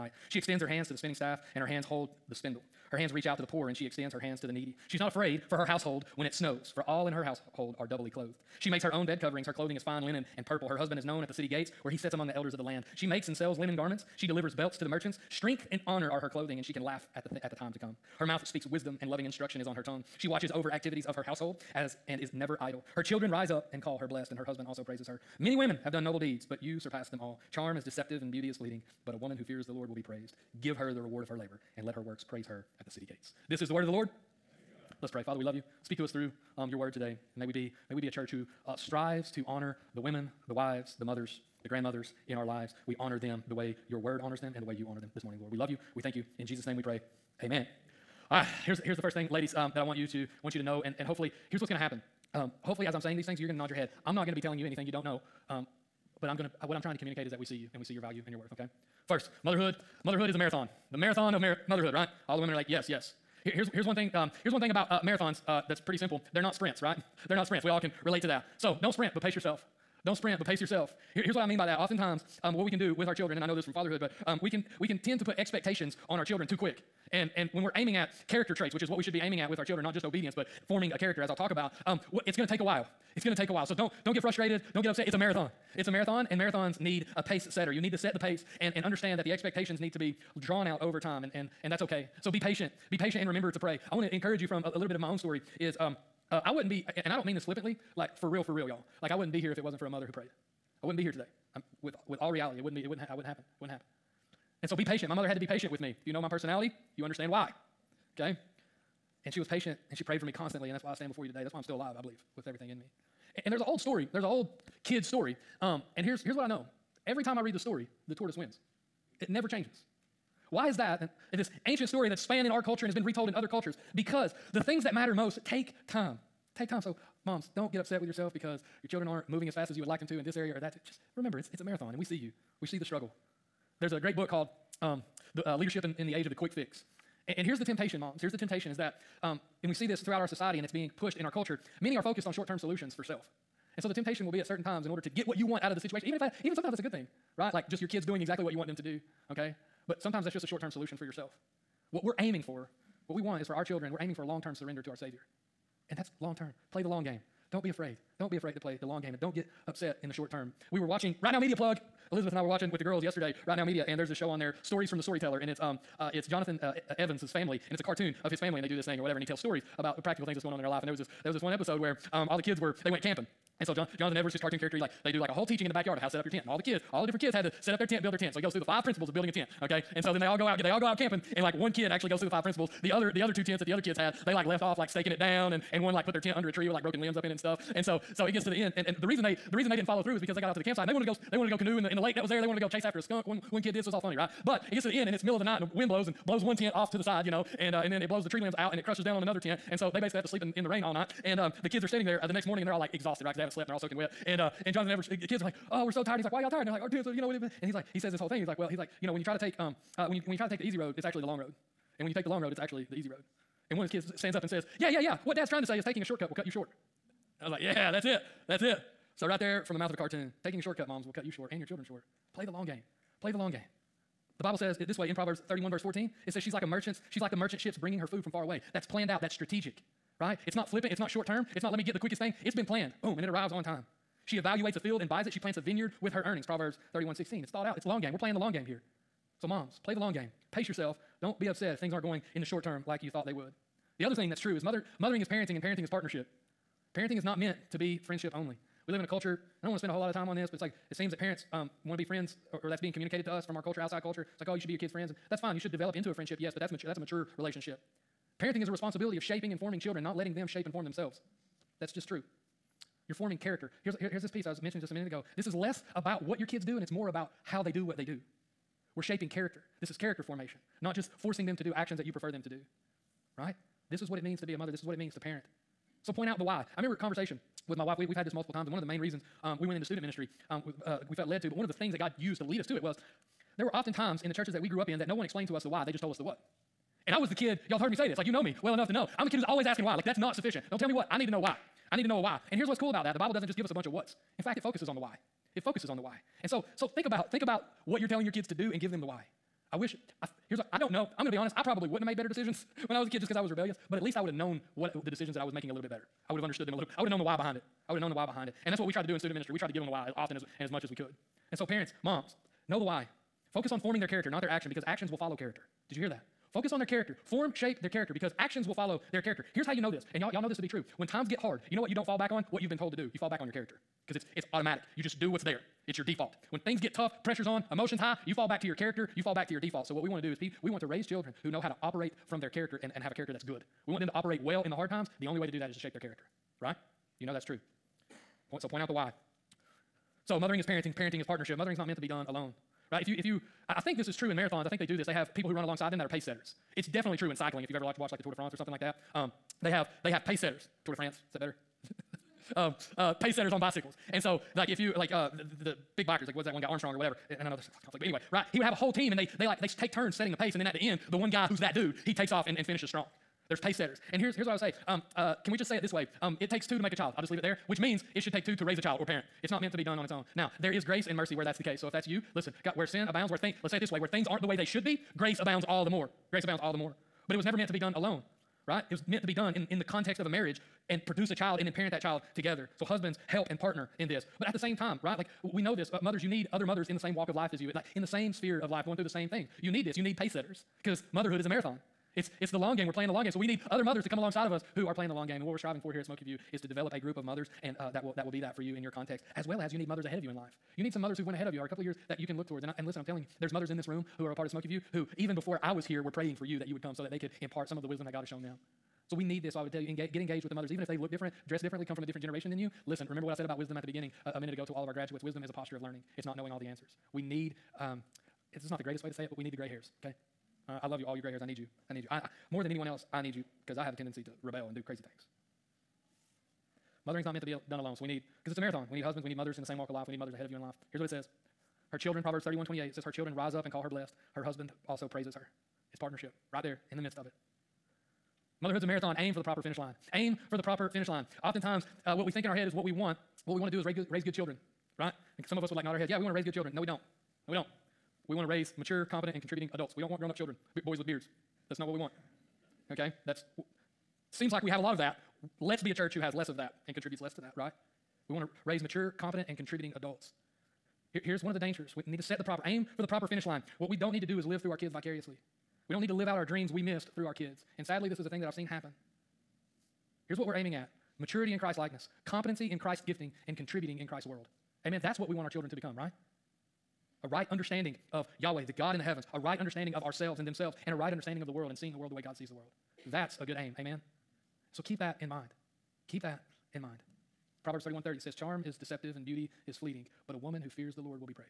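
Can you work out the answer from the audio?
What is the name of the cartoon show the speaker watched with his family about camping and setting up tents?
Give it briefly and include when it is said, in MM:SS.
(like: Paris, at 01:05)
Stories from the Storyteller, at 02:44.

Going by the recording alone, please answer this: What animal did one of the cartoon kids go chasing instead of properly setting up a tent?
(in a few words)
A skunk.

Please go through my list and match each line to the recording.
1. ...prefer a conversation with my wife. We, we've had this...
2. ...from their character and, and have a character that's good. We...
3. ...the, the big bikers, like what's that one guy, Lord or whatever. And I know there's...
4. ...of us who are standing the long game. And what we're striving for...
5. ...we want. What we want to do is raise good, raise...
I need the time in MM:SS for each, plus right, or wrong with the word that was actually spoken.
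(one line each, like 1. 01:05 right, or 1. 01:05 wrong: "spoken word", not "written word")
1. 04:36 wrong: "remember", not "prefer"
2. 05:32 right
3. 05:55 wrong: "Armstrong", not "Lord"
4. 06:34 wrong: "playing", not "standing"
5. 07:22 right.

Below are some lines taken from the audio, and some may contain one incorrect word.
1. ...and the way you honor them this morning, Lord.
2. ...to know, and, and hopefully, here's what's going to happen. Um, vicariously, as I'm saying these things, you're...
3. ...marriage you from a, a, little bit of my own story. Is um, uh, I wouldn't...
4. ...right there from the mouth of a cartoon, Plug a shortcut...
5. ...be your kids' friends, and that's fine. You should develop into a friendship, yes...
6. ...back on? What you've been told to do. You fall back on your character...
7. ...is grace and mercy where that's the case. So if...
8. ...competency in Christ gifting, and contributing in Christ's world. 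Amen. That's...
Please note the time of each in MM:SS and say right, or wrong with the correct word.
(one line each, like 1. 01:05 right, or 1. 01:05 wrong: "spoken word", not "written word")
1. 00:44 right
2. 00:50 wrong: "hopefully", not "vicariously"
3. 01:34 wrong: "encourage", not "marriage"
4. 03:39 wrong: "Taking", not "Plug"
5. 04:14 right
6. 05:22 right
7. 06:10 right
8. 07:52 right.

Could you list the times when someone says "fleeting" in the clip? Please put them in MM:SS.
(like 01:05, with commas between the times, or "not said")
00:28, 08:09.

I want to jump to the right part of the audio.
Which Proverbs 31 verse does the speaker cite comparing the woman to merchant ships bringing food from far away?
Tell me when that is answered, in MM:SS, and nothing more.
03:45.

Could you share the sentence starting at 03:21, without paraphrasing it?
And um, the kids are standing there uh, the next morning and they're all like exhausted, right?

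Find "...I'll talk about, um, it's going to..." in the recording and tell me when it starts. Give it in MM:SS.
01:21.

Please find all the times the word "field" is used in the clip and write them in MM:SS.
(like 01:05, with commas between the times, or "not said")
03:54.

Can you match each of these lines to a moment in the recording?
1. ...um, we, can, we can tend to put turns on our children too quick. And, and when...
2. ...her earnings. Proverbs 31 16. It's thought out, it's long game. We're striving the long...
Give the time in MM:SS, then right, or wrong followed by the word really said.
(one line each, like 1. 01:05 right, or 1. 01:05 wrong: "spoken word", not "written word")
1. 01:14 wrong: "expectations", not "turns"
2. 03:56 wrong: "playing", not "striving".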